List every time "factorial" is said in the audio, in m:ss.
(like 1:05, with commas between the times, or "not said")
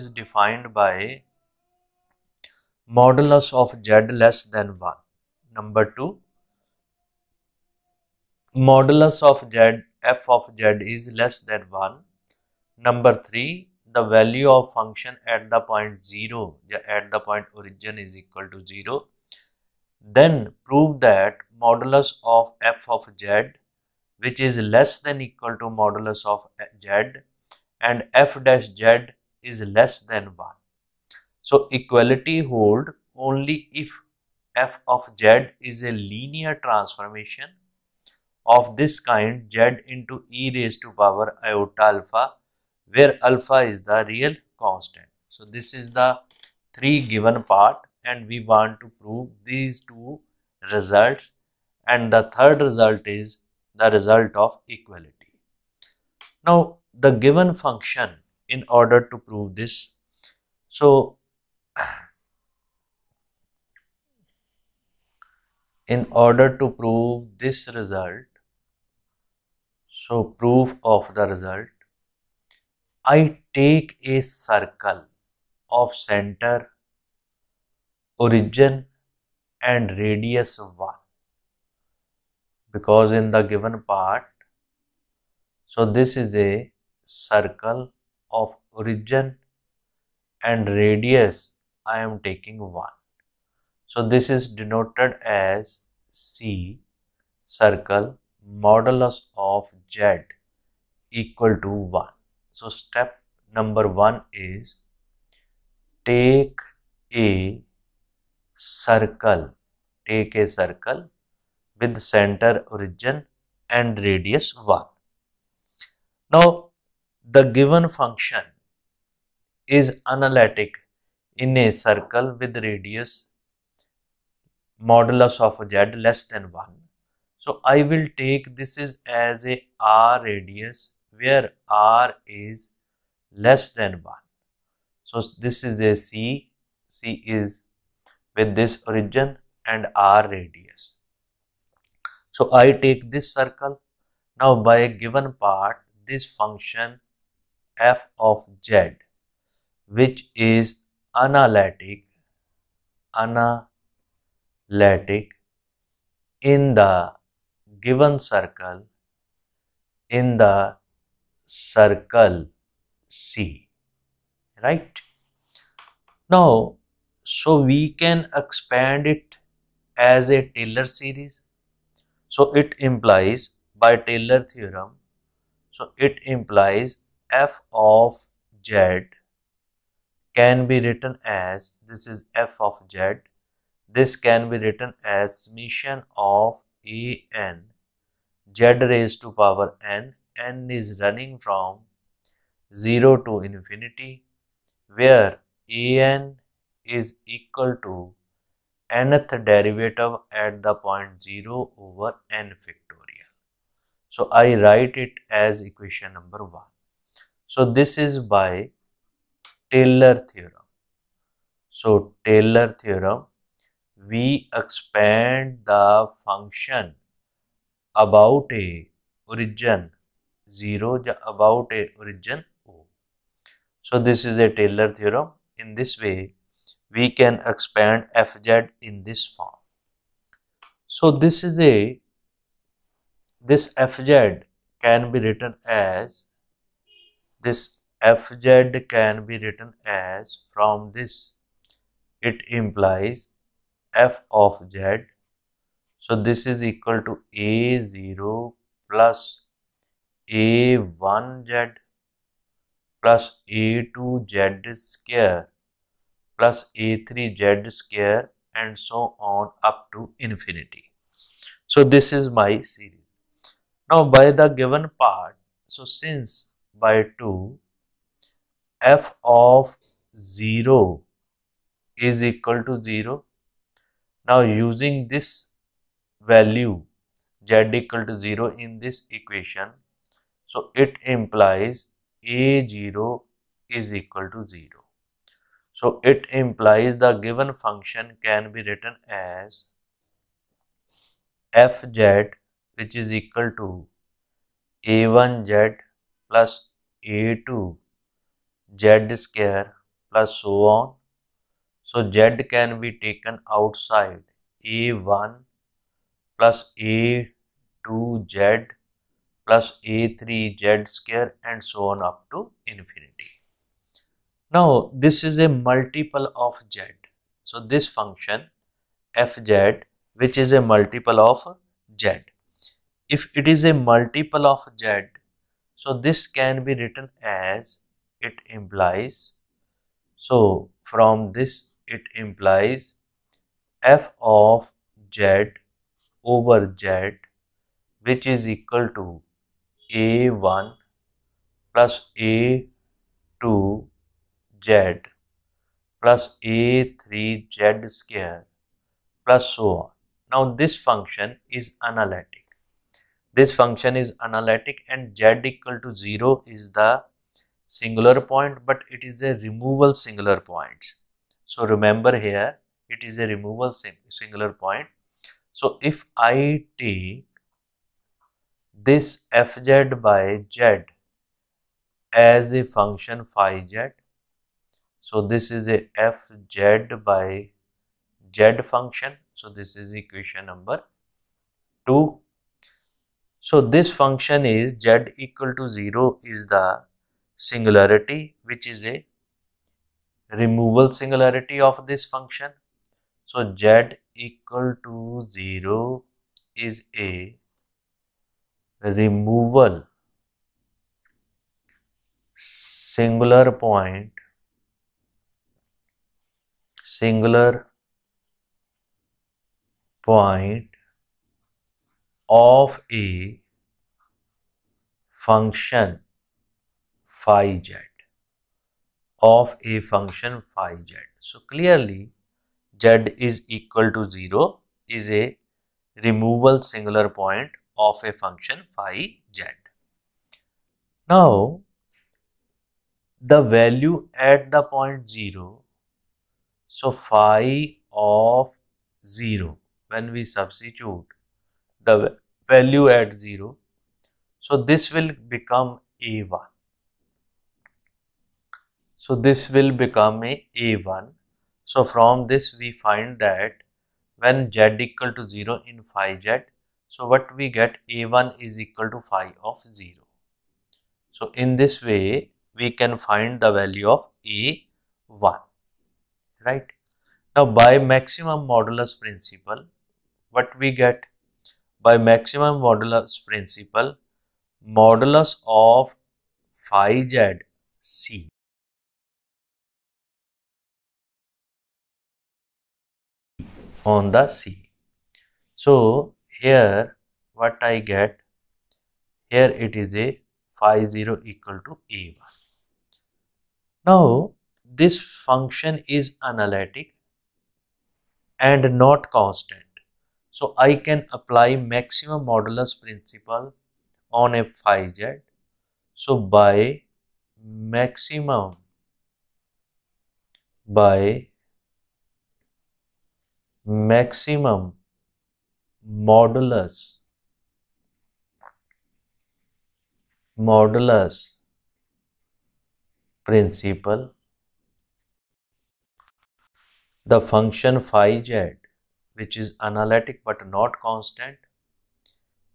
3:22.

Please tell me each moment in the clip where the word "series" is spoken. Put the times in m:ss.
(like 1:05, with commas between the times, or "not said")
2:50, 4:22.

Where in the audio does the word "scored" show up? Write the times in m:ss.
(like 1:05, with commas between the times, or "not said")
not said.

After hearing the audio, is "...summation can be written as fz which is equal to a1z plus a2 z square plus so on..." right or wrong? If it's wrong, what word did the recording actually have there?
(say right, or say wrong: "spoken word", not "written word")
wrong: "function", not "summation".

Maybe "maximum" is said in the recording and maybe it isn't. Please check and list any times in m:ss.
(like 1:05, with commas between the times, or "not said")
7:47, 7:51, 8:21, 8:27, 8:33.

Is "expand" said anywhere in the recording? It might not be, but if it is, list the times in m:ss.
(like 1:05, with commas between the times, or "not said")
2:48, 3:34, 3:47.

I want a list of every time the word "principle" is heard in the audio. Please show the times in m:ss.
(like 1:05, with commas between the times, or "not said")
7:49, 7:53, 8:22, 8:43.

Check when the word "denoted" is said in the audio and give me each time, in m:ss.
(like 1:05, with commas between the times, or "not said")
1:34.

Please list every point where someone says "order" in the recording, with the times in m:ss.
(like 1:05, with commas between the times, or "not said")
0:58, 1:06.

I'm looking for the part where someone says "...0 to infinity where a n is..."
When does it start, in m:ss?
3:12.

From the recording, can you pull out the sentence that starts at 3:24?
So I write it as equation number 1.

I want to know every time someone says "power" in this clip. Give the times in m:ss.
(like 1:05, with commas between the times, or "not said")
0:41, 3:09.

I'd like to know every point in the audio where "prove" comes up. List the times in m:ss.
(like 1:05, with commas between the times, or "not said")
0:20, 0:49, 0:59, 1:06.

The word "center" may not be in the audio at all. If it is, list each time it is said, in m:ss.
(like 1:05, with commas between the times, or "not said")
1:15, 1:51.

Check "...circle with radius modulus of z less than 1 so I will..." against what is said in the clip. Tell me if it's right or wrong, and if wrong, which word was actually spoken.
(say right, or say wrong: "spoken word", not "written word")
right.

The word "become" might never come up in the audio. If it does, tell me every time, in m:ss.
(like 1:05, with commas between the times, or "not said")
7:25, 7:29.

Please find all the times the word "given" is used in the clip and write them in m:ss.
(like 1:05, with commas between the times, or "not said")
0:47, 0:57, 1:23, 1:57, 2:25, 2:37, 4:24, 4:47.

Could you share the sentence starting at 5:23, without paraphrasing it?
If it is a multiple of z, so this can be written as it implies.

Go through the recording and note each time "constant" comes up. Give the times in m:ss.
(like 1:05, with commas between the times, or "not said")
0:44, 8:19, 8:50.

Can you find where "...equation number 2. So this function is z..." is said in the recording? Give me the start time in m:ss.
6:19.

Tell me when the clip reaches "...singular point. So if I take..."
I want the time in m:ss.
6:04.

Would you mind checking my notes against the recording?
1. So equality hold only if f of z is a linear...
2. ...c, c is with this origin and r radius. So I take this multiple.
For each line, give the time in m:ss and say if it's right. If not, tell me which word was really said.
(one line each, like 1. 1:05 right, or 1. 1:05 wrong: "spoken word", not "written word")
1. 0:31 right
2. 2:15 wrong: "circle", not "multiple".